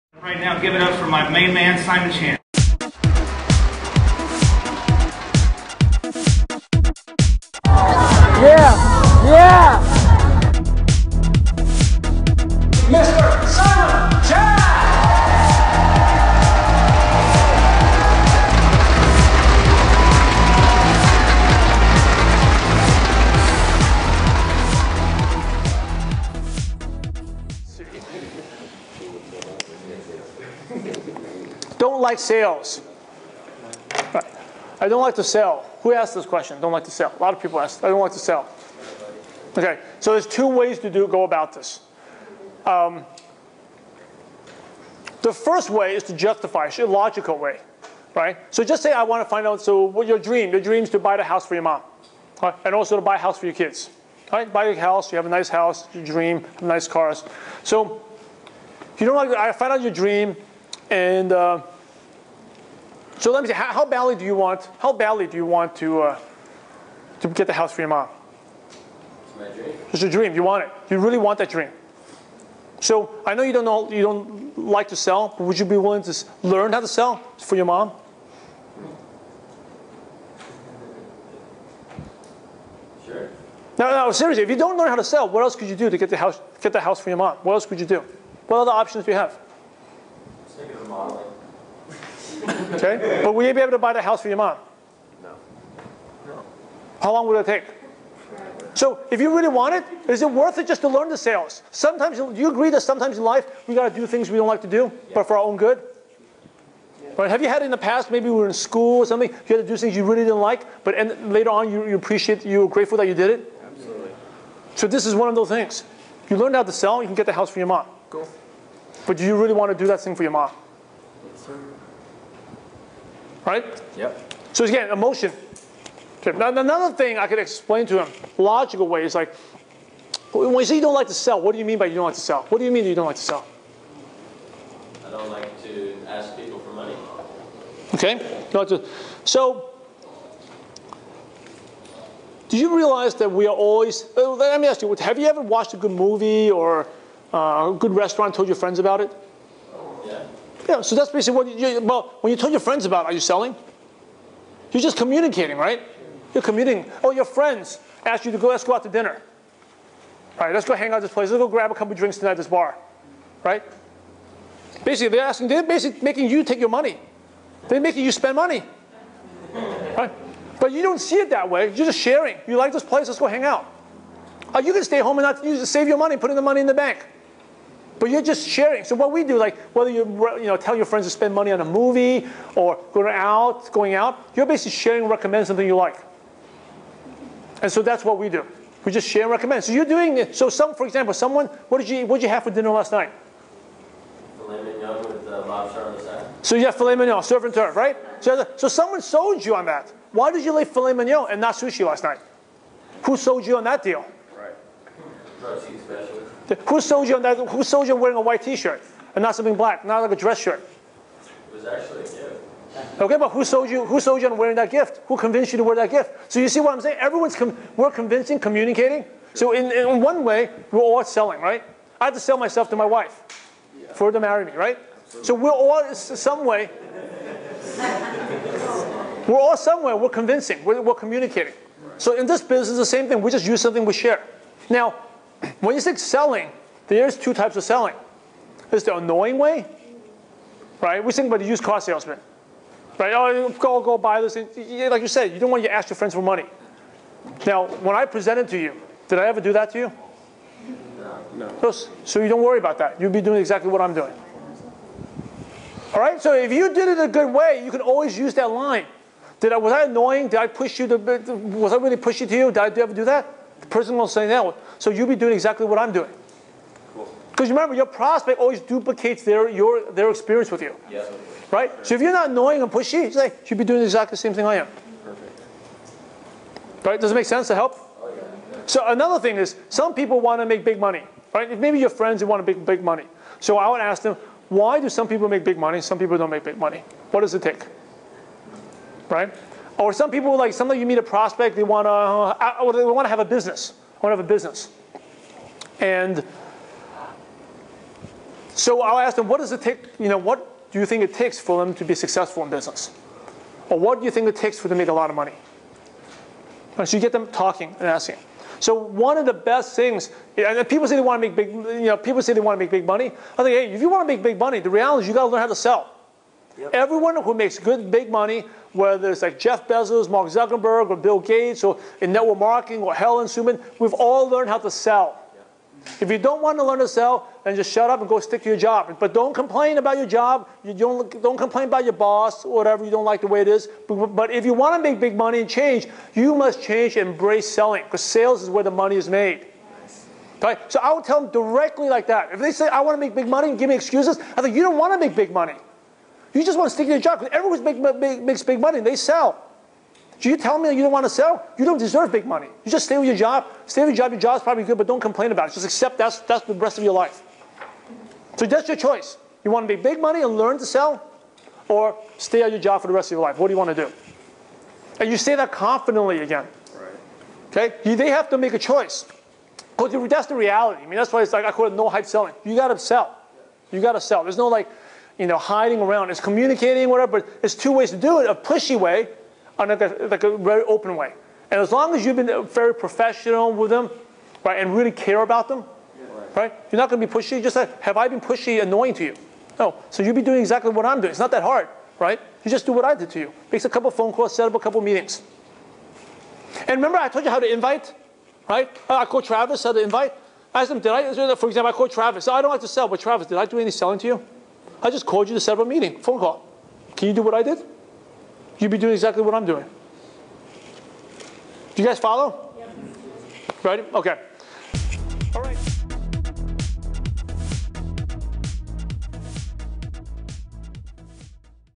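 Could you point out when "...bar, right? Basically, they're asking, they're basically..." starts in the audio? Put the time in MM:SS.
02:42.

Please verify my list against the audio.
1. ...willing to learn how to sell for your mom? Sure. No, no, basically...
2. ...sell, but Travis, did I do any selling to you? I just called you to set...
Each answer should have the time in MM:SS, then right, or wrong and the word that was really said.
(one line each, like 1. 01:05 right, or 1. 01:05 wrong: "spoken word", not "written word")
1. 01:15 wrong: "seriously", not "basically"
2. 06:42 right.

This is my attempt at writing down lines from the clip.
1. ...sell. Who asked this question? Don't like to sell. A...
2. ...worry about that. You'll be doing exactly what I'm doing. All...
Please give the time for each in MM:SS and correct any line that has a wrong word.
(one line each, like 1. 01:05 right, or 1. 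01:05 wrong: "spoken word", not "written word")
1. 00:35 right
2. 04:12 right.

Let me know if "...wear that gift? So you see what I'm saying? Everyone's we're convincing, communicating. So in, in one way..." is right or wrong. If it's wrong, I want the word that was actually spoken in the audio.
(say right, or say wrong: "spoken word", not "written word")
right.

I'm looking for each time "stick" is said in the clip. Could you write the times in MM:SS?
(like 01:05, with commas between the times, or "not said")
05:28, 05:46.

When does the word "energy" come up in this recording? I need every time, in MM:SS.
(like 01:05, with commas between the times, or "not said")
not said.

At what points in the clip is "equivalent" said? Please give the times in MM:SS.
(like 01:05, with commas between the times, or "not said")
not said.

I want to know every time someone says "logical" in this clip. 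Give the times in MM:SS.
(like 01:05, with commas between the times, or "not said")
00:46, 02:08.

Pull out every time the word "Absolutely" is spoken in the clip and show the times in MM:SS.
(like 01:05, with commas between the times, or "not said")
01:53, 03:45.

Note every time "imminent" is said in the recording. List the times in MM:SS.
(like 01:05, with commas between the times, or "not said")
not said.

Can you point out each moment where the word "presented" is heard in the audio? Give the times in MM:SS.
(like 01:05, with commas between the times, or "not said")
04:08.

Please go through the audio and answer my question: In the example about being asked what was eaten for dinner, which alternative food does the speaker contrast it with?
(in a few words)
Sushi.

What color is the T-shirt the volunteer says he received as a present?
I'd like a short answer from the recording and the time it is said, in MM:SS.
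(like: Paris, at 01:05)
White, at 03:28.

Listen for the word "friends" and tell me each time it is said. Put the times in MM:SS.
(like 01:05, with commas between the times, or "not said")
02:28, 02:32, 02:37, 03:00, 04:05, 04:41.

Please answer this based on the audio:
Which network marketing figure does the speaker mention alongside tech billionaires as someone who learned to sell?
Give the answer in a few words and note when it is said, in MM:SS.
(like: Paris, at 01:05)
Helen Suman, at 05:22.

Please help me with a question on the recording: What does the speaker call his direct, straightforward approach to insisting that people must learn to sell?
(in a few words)
No hype selling.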